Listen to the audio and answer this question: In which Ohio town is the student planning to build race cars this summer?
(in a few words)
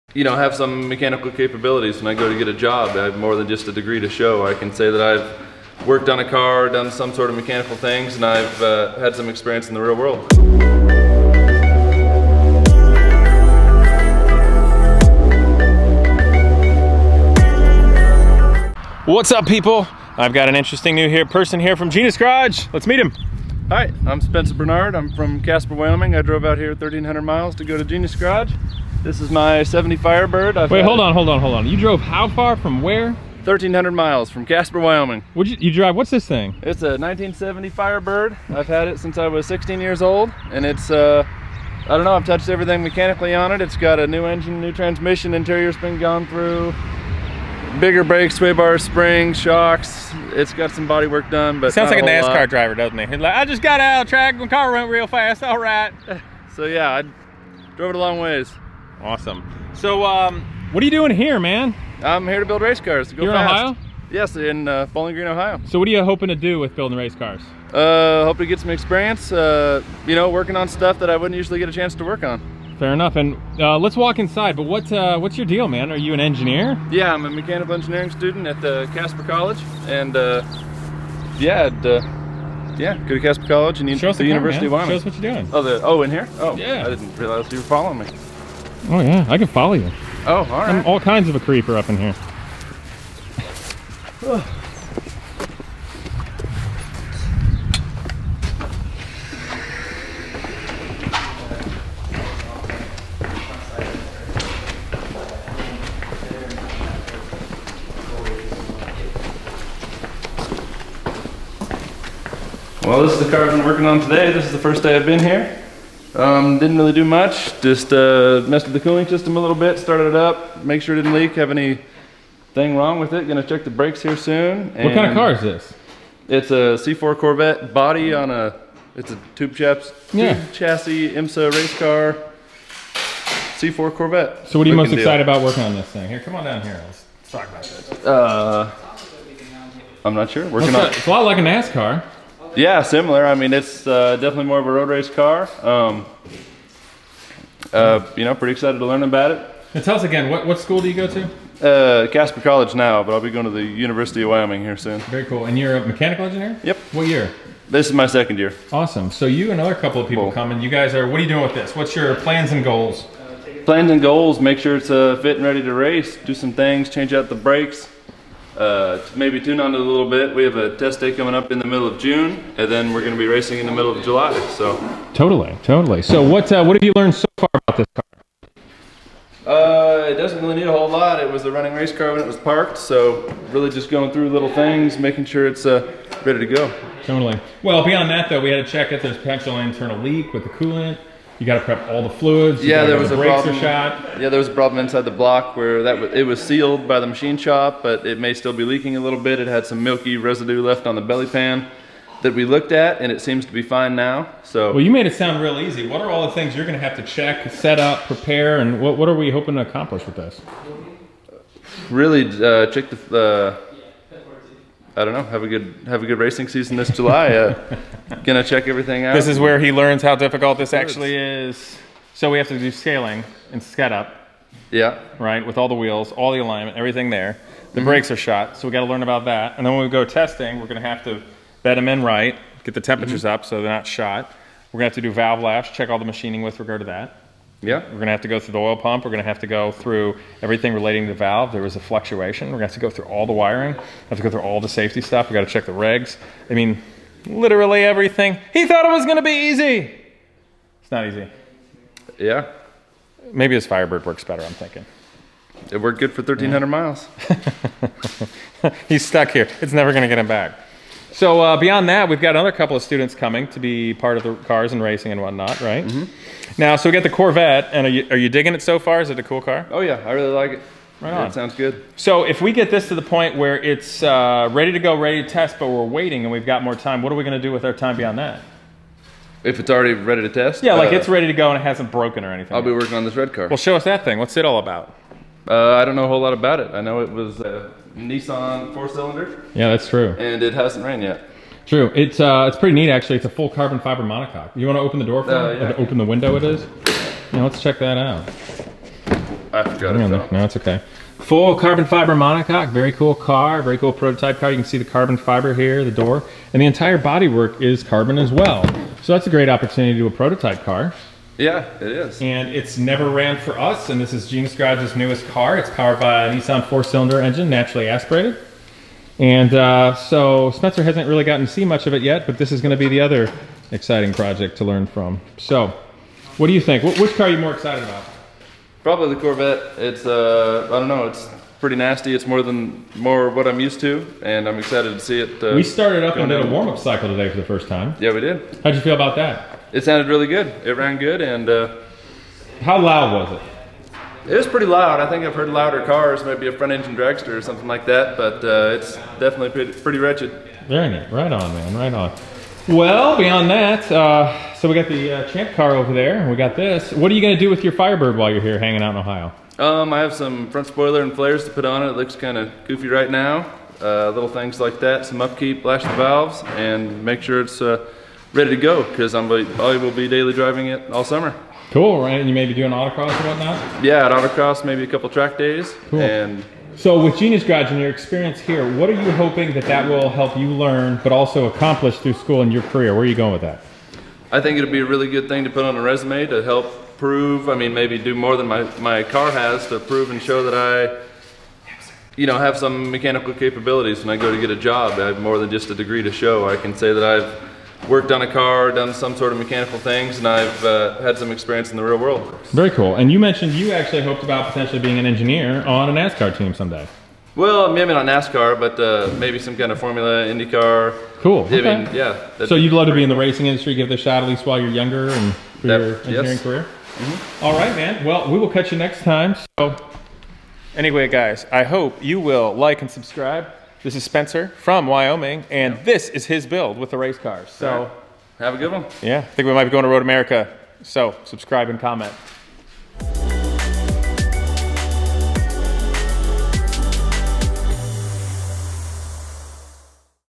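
Bowling Green.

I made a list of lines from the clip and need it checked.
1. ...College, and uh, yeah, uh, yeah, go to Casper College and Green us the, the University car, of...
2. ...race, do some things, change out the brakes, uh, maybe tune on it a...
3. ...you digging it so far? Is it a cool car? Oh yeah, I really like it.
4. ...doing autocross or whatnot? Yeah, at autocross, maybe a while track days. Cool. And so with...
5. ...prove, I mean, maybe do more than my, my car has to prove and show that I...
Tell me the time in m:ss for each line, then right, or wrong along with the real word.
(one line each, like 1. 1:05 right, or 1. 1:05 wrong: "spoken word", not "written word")
1. 1:19 wrong: "Show", not "Green"
2. 2:45 right
3. 4:28 right
4. 6:12 wrong: "couple", not "while"
5. 6:26 right.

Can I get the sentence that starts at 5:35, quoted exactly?
Uh, we started up and did a warm-up cycle today for the first time.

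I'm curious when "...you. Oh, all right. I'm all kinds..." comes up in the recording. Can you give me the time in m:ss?
1:29.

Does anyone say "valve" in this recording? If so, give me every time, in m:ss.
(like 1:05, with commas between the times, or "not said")
3:55, 4:01, 6:05.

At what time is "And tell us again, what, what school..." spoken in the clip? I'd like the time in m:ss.
2:29.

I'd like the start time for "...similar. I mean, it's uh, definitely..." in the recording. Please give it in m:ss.
2:22.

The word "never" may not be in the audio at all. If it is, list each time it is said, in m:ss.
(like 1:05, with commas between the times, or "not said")
4:19, 5:12.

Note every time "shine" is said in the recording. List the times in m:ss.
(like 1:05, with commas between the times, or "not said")
not said.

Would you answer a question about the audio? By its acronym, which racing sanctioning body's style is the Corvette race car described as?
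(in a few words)
IMSA.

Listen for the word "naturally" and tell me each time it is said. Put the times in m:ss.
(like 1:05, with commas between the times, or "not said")
5:17.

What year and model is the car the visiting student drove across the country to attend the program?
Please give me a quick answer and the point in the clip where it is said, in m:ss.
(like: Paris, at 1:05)
1970 Firebird, at 0:36.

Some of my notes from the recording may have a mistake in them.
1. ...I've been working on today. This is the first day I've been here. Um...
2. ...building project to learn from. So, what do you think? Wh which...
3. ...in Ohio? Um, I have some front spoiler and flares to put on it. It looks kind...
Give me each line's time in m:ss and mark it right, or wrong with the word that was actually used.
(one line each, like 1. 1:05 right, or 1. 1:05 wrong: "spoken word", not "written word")
1. 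1:53 right
2. 5:23 wrong: "exciting", not "building"
3. 5:58 right.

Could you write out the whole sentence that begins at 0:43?
It's got a new engine, new transmission, interior's been gone through, bigger brakes, sway bar, springs, shocks.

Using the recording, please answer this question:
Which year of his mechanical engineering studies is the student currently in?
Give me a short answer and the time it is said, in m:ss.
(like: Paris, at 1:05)
Second year, at 2:38.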